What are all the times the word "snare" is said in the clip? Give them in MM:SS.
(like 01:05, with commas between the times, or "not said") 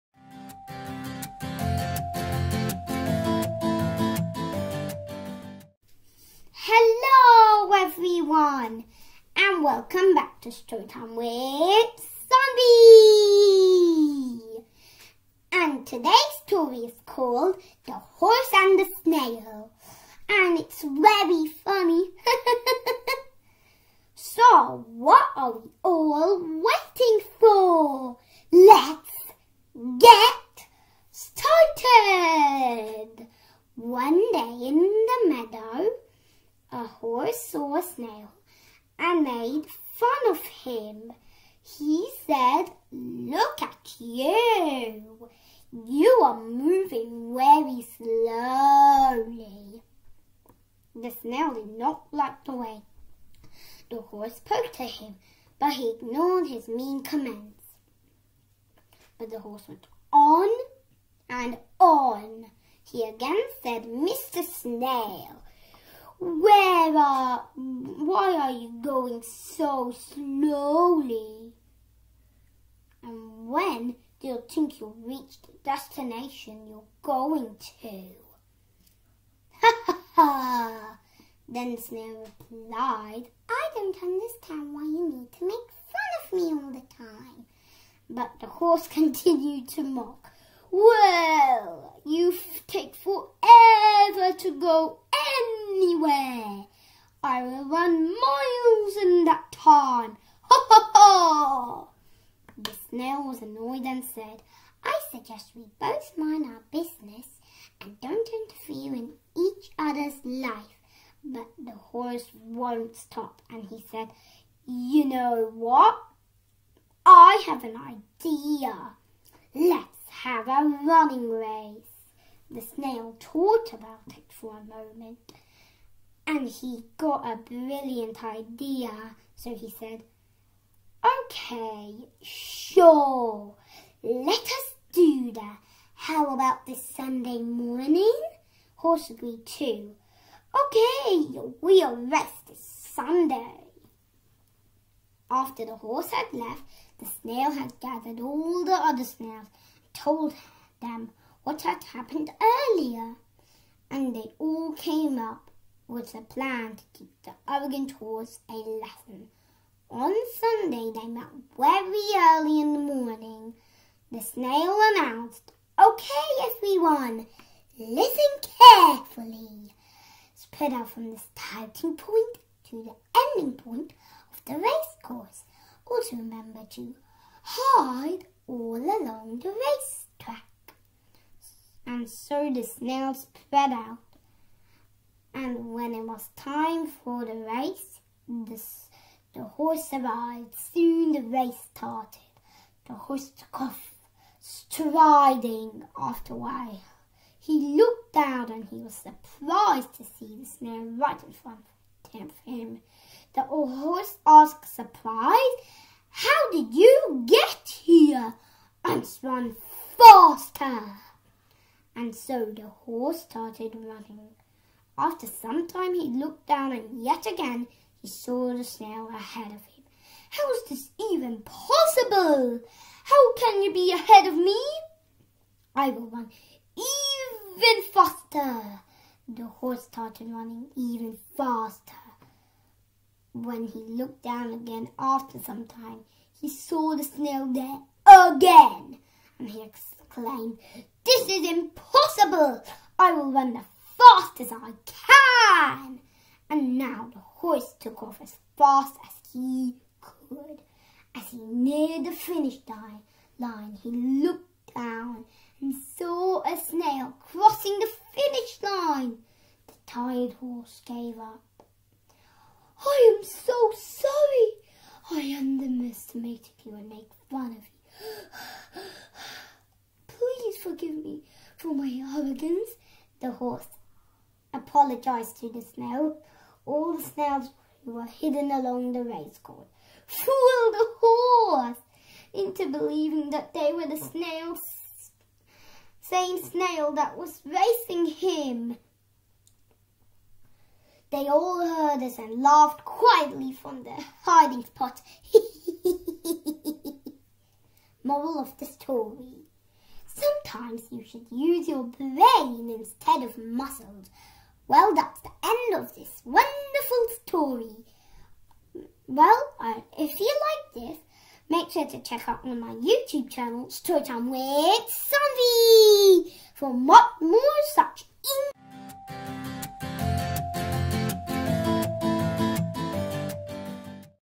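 01:21, 03:20.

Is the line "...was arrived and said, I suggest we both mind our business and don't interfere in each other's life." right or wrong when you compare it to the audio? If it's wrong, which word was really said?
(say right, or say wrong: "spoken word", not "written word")
wrong: "annoyed", not "arrived".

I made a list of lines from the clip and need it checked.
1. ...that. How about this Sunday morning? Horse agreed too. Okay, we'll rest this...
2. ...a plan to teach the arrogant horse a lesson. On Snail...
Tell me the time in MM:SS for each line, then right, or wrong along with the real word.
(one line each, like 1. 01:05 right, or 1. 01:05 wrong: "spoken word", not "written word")
1. 02:15 right
2. 02:36 wrong: "Sunday", not "Snail".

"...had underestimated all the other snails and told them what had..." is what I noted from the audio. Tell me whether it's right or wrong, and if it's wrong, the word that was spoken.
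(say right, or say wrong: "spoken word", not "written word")
wrong: "gathered", not "underestimated".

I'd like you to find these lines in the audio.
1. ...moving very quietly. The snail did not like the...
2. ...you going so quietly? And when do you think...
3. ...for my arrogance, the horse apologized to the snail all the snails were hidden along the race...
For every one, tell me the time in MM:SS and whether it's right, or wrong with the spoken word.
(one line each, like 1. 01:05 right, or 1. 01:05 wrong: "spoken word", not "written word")
1. 00:46 wrong: "slowly", not "quietly"
2. 01:08 wrong: "slowly", not "quietly"
3. 04:31 right.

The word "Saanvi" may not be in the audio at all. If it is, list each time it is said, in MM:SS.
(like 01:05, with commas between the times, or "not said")
00:12, 05:15.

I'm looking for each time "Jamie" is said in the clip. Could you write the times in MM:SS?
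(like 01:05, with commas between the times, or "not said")
not said.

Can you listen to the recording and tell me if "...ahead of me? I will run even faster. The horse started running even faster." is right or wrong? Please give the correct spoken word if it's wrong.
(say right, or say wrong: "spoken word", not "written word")
right.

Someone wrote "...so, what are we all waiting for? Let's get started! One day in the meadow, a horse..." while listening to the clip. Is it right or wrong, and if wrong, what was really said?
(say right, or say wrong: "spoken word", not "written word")
right.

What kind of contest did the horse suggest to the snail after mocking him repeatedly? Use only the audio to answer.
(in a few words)
A running race.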